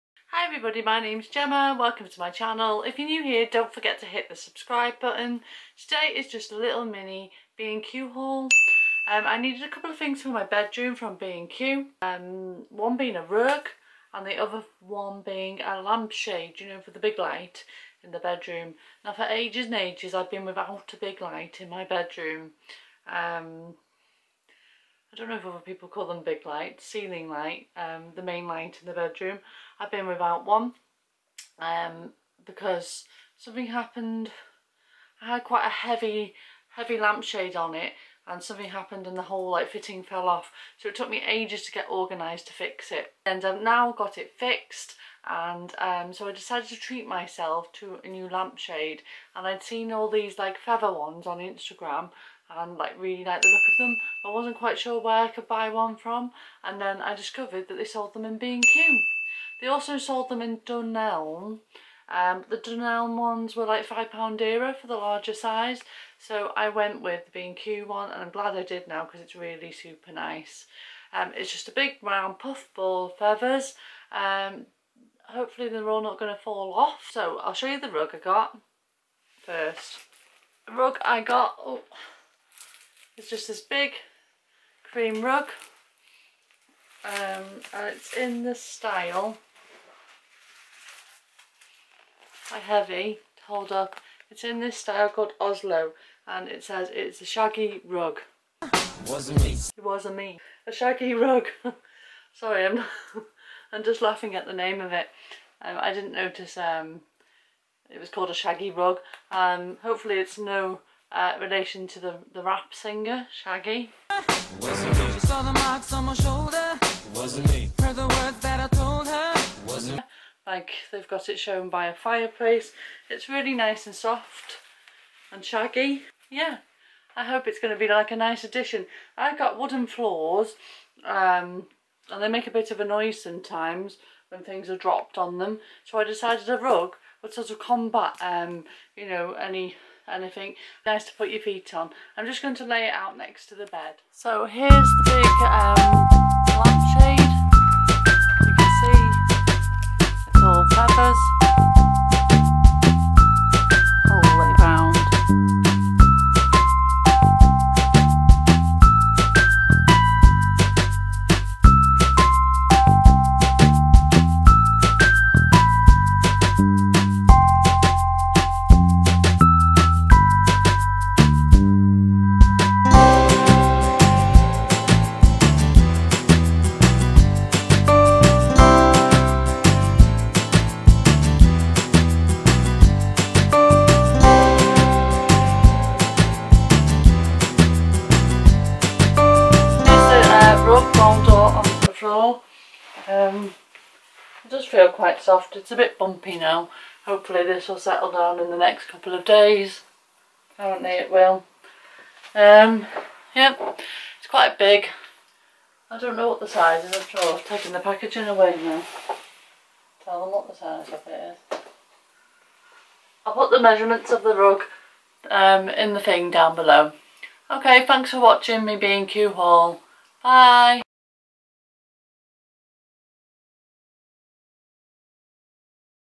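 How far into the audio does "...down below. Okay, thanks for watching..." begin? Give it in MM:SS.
03:36.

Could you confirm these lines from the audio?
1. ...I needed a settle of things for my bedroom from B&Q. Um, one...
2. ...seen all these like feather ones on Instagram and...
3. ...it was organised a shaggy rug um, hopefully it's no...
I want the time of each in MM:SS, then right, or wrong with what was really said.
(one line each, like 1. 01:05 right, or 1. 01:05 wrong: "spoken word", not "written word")
1. 00:09 wrong: "couple", not "settle"
2. 00:49 right
3. 01:47 wrong: "called", not "organised".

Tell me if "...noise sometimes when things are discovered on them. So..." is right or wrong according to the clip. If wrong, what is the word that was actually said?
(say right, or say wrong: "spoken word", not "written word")
wrong: "dropped", not "discovered".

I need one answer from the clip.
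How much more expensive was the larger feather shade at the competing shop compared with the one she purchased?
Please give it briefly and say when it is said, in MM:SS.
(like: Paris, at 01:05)
£5, at 01:03.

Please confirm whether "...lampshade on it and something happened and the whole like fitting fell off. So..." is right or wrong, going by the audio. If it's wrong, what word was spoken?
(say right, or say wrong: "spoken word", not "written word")
right.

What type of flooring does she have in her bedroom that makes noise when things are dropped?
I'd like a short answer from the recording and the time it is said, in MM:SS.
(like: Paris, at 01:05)
wooden floors, at 02:09.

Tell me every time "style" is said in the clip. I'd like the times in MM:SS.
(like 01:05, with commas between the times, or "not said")
01:28, 01:34.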